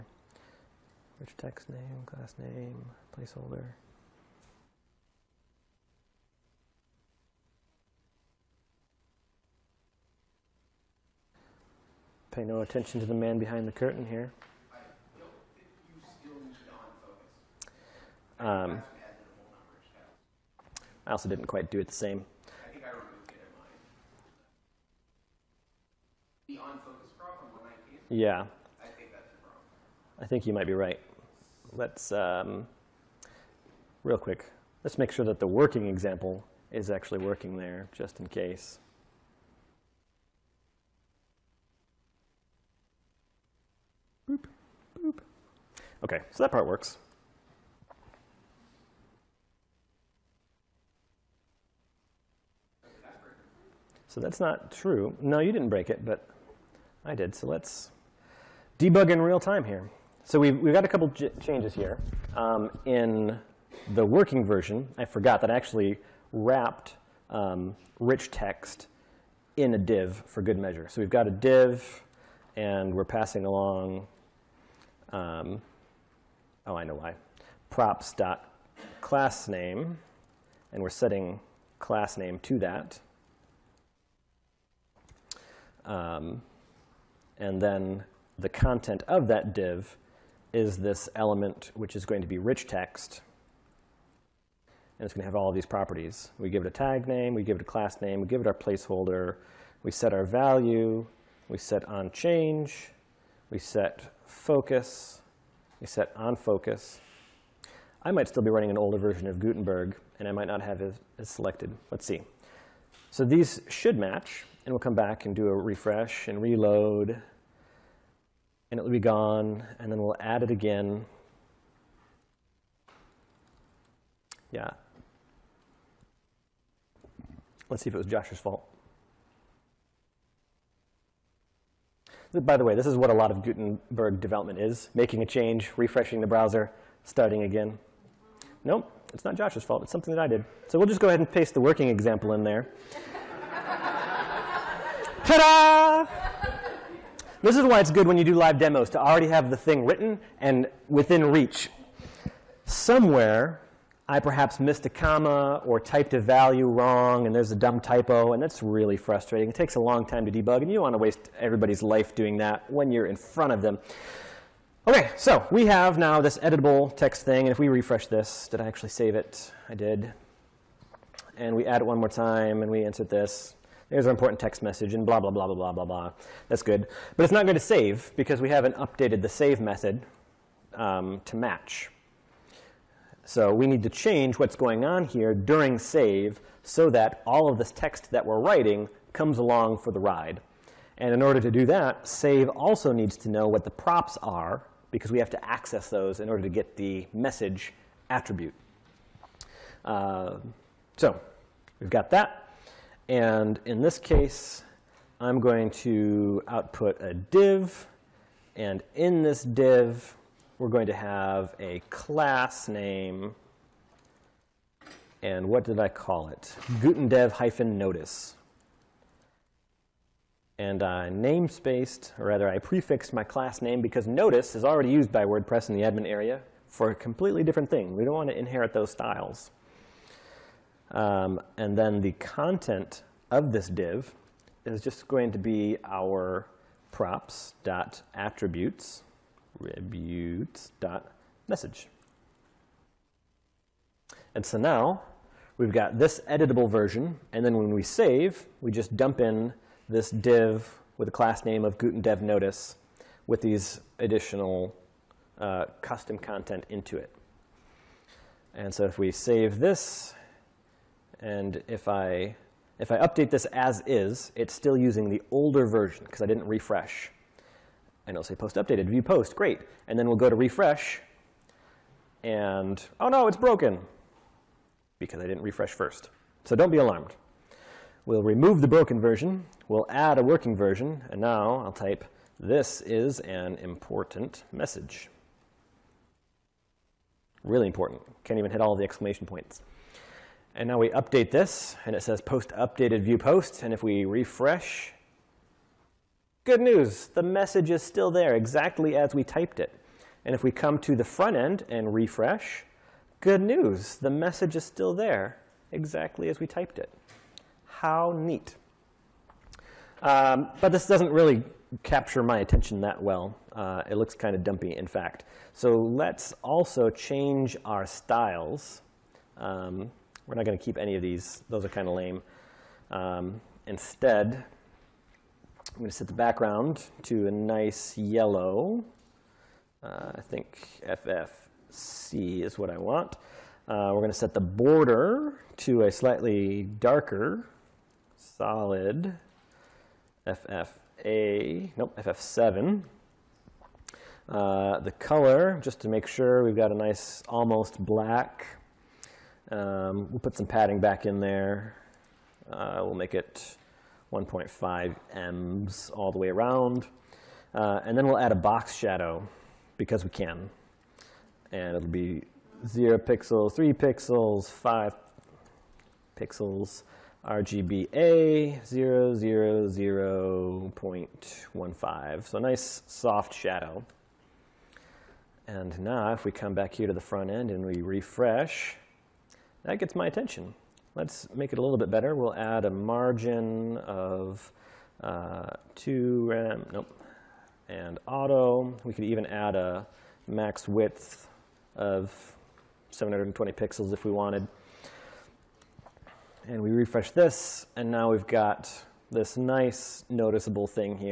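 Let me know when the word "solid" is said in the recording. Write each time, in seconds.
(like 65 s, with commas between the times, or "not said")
338 s.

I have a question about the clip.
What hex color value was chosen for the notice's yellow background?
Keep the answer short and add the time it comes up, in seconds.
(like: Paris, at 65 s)
FFC, at 330 s.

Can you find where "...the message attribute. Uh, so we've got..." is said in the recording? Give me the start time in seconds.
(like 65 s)
196 s.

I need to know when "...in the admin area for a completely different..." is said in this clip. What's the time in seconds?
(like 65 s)
225 s.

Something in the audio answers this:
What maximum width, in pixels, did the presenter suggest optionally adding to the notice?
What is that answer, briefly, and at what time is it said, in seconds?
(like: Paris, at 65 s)
720 pixels, at 392 s.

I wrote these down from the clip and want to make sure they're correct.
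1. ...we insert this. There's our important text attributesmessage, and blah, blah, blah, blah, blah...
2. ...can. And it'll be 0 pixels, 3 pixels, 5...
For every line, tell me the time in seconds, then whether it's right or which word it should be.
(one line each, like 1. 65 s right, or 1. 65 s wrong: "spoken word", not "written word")
1. 172 s wrong: "message", not "attributesmessage"
2. 360 s right.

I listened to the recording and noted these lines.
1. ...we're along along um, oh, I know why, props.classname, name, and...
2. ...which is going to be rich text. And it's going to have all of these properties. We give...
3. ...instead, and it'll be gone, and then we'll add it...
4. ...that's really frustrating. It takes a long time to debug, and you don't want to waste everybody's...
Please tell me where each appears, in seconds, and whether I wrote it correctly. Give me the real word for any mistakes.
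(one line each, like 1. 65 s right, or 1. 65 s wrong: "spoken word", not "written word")
1. 72 s wrong: "passing", not "along"
2. 91 s right
3. 116 s wrong: "reload", not "instead"
4. 158 s right.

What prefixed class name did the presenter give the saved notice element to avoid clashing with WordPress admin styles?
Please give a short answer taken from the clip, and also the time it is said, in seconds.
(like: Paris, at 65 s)
Gutendev-notice, at 216 s.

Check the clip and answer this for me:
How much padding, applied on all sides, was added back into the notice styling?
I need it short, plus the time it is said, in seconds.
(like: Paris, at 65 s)
1.5 ems, at 354 s.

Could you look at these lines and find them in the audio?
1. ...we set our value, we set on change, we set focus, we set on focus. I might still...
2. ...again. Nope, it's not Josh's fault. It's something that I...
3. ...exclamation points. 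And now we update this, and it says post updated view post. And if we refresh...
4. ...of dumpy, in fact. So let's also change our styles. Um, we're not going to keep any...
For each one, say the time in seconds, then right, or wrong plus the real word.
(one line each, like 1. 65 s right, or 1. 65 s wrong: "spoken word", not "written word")
1. 99 s right
2. 137 s right
3. 288 s right
4. 314 s right.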